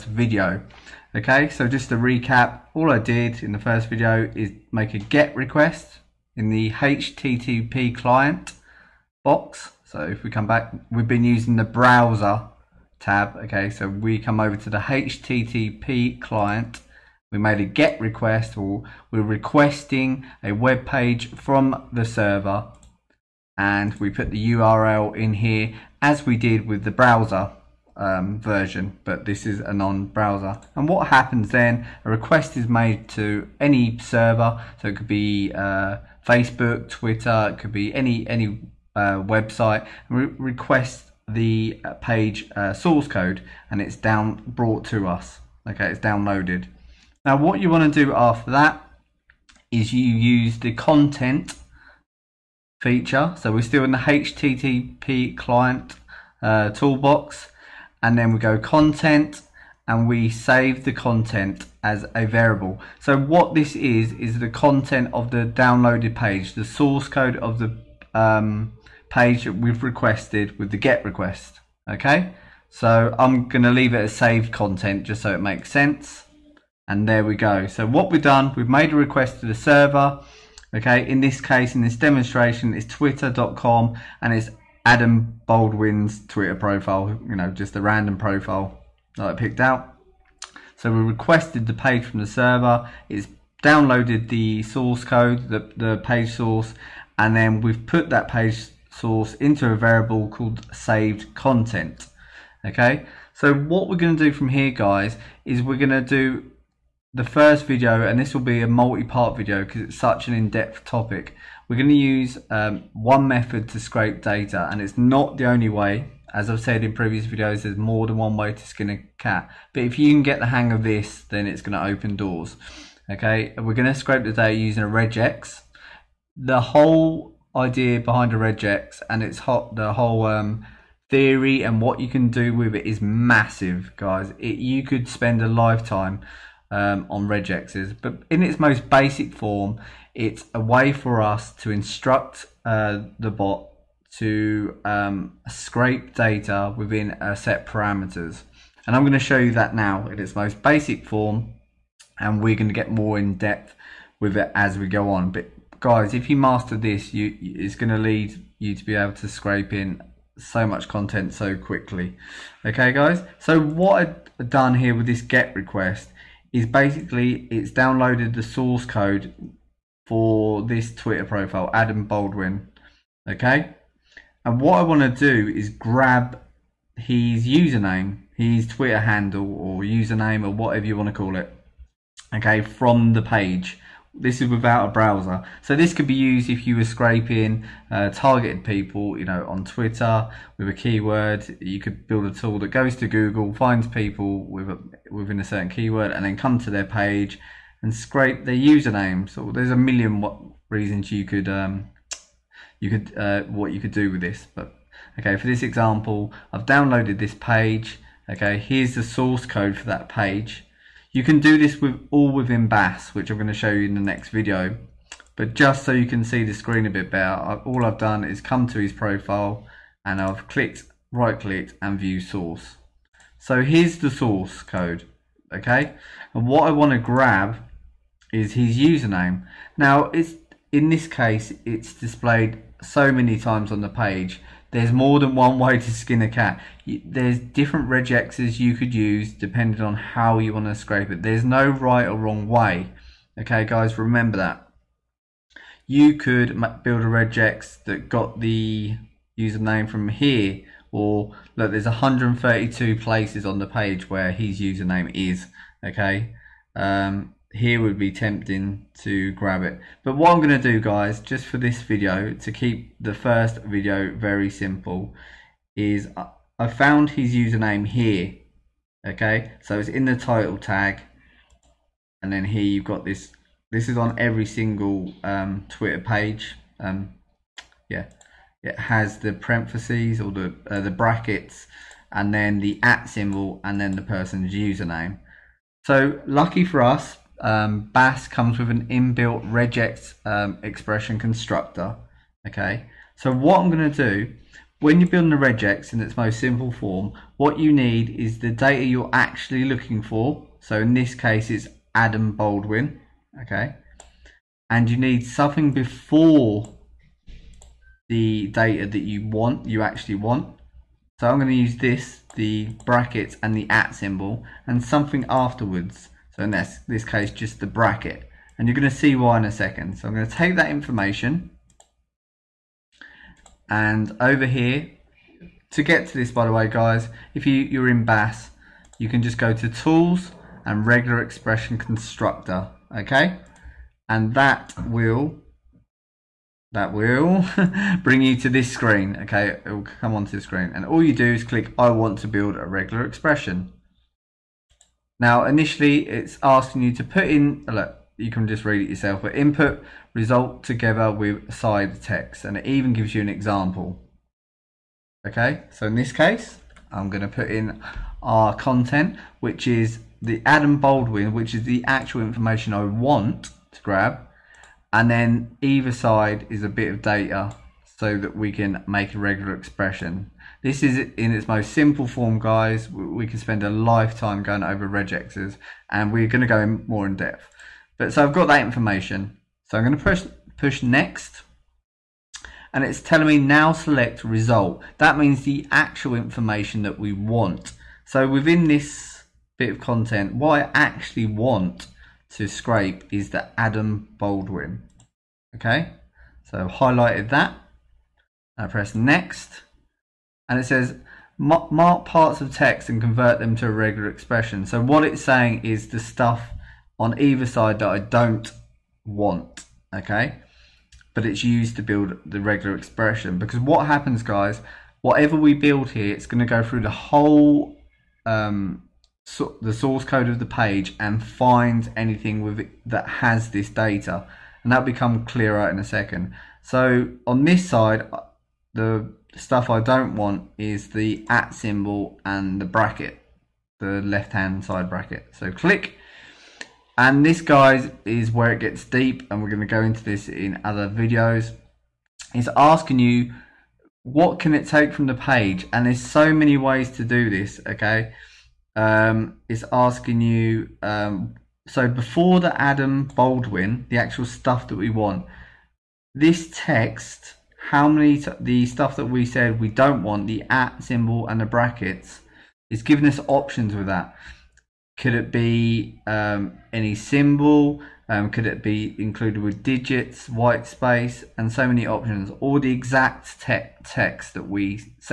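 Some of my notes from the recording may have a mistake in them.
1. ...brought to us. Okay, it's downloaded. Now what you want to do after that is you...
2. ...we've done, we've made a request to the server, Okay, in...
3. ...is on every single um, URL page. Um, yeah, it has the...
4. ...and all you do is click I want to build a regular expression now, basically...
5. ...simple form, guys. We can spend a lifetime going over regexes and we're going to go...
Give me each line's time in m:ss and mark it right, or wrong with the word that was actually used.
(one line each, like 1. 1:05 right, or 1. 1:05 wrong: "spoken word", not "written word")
1. 0:44 right
2. 1:18 right
3. 4:33 wrong: "Twitter", not "URL"
4. 5:40 wrong: "initially", not "basically"
5. 6:11 right.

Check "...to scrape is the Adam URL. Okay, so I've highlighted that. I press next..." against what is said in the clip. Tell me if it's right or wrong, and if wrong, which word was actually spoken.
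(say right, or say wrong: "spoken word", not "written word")
wrong: "Baldwin", not "URL".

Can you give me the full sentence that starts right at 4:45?
So lucky for us, um, BAS comes with an inbuilt regex um, expression constructor.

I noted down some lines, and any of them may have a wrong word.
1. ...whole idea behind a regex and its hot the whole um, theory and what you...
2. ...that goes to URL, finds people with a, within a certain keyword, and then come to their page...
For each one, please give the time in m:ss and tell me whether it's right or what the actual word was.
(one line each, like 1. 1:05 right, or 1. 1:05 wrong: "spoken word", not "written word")
1. 2:06 right
2. 3:12 wrong: "Google", not "URL".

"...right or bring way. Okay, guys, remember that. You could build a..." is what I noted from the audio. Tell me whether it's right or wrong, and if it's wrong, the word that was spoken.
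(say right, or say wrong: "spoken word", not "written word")
wrong: "wrong", not "bring".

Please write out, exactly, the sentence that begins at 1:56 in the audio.
As I've said in previous videos, there's more than one way to skin a cat.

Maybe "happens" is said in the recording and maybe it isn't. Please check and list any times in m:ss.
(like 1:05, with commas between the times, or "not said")
0:31, 6:53.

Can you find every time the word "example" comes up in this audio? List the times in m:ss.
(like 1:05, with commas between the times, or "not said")
3:25, 5:53.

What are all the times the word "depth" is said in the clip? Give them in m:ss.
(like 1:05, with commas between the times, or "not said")
1:50, 2:33, 6:17.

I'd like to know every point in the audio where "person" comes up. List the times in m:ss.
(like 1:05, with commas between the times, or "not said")
4:44.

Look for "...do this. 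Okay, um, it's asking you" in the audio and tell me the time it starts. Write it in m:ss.
7:27.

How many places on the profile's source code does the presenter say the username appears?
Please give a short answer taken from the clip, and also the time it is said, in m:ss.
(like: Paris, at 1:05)
132, at 4:11.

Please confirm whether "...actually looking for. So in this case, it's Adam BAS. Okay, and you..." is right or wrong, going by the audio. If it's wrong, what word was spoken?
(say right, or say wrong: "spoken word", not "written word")
wrong: "Baldwin", not "BAS".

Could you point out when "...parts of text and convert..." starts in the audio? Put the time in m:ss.
6:42.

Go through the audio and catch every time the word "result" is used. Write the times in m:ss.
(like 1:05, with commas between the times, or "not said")
5:50, 6:24.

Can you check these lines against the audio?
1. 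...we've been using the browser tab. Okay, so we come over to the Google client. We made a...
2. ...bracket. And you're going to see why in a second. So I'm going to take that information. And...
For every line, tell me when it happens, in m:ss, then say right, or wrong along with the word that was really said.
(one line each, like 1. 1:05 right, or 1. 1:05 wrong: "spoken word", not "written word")
1. 0:10 wrong: "HTTP", not "Google"
2. 5:17 right.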